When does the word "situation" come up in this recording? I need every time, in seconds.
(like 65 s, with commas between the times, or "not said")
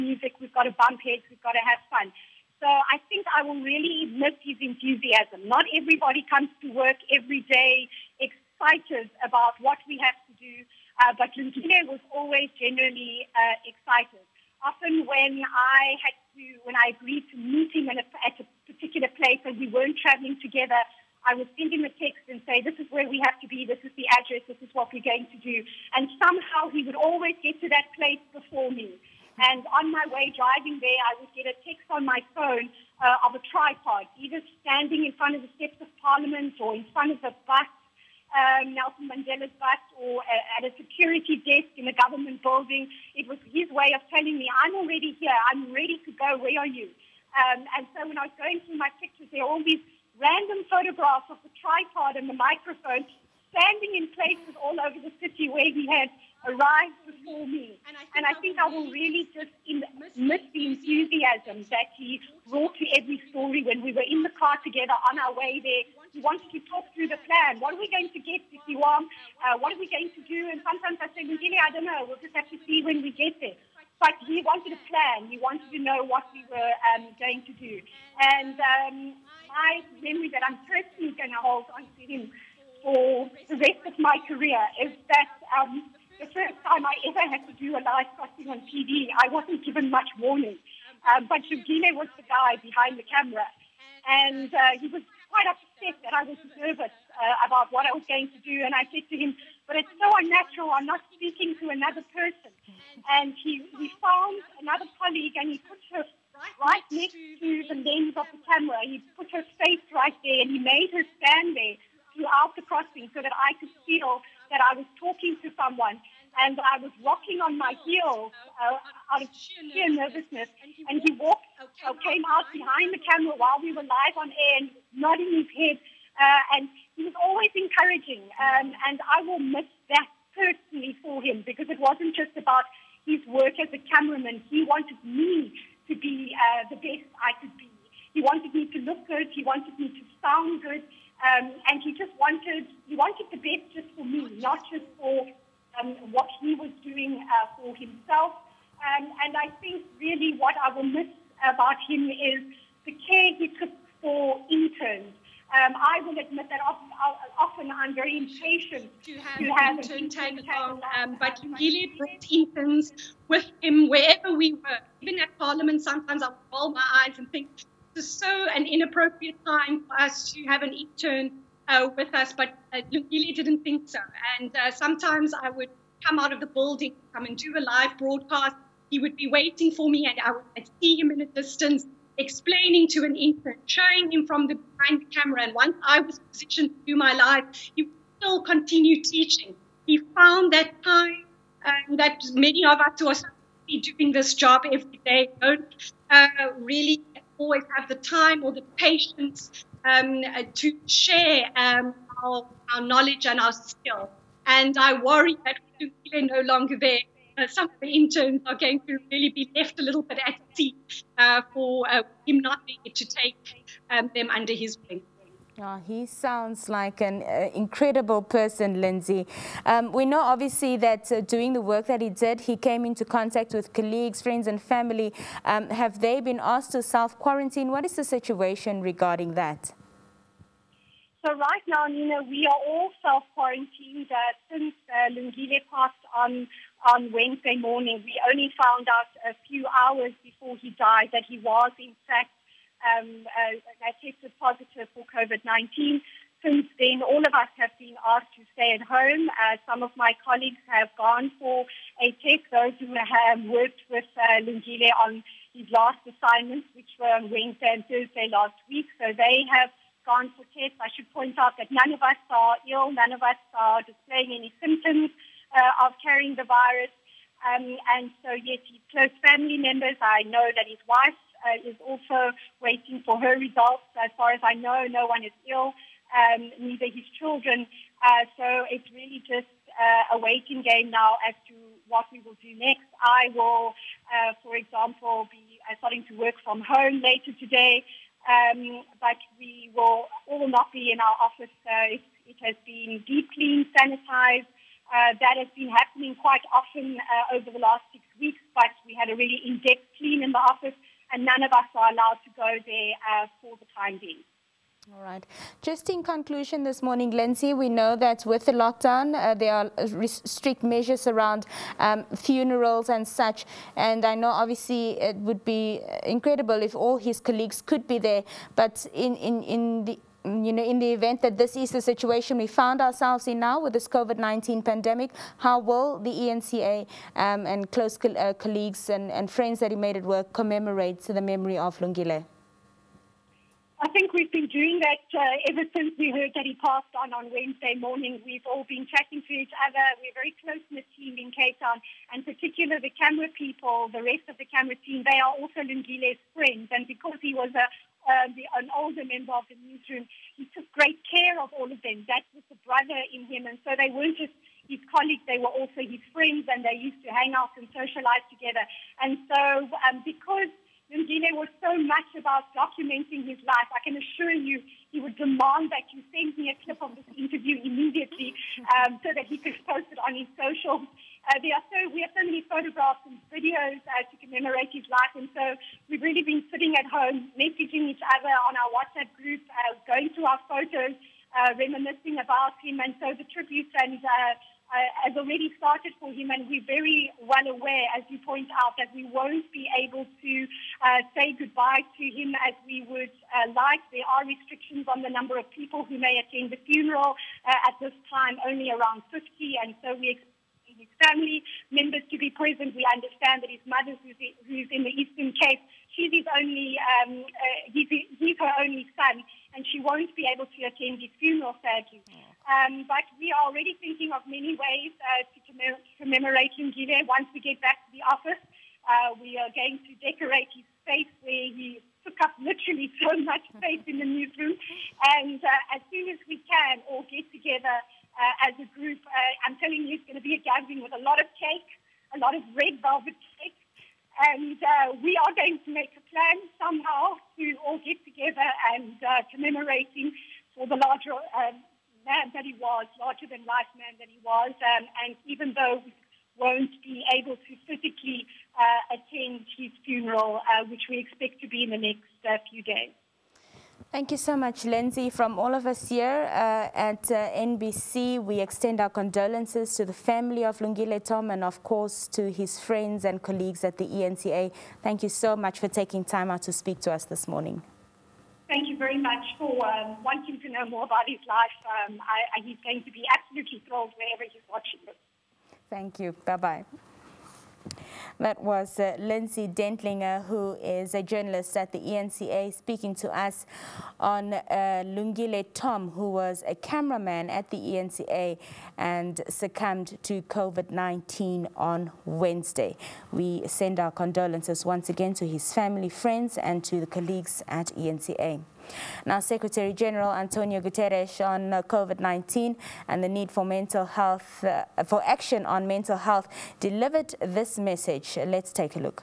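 228 s, 321 s.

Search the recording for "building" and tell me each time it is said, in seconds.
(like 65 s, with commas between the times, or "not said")
42 s, 176 s.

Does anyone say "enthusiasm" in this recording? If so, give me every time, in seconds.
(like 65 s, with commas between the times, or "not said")
4 s, 60 s.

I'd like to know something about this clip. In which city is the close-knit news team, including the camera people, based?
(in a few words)
Cape Town.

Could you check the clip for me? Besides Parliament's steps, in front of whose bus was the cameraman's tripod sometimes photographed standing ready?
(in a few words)
Nelson Mandela.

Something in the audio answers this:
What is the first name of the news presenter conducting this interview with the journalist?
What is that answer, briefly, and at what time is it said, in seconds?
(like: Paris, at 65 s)
Nina, at 231 s.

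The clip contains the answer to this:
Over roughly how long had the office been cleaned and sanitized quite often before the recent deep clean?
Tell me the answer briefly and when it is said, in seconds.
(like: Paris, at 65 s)
6 weeks, at 297 s.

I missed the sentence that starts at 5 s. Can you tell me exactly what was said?
Not everybody comes to work every day excited about what we have to do, uh, but Lungile was always genuinely uh, excited.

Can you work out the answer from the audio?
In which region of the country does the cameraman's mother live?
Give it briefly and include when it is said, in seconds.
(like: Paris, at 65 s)
Eastern Cape, at 404 s.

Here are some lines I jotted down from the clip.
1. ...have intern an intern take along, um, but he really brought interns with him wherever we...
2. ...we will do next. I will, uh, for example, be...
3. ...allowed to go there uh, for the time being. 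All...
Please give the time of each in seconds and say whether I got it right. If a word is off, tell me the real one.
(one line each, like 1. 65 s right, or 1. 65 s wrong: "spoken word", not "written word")
1. 159 s right
2. 282 s right
3. 301 s right.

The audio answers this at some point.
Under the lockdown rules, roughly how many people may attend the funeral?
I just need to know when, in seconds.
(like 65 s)
399 s.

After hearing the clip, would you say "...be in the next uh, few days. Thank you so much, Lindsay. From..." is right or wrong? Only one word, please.
right.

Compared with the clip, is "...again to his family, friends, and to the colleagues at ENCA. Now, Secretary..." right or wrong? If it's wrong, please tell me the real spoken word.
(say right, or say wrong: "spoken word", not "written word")
right.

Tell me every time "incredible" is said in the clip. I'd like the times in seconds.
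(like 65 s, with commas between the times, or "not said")
217 s, 316 s.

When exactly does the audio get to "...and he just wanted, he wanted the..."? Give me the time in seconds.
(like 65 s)
141 s.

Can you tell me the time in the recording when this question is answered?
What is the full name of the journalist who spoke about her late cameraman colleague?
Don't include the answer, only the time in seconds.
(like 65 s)
478 s.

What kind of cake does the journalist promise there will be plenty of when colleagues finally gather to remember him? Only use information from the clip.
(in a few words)
Red velvet.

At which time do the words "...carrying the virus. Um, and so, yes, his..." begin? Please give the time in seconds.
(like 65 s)
266 s.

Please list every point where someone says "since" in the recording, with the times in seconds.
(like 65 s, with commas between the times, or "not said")
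234 s, 246 s, 335 s.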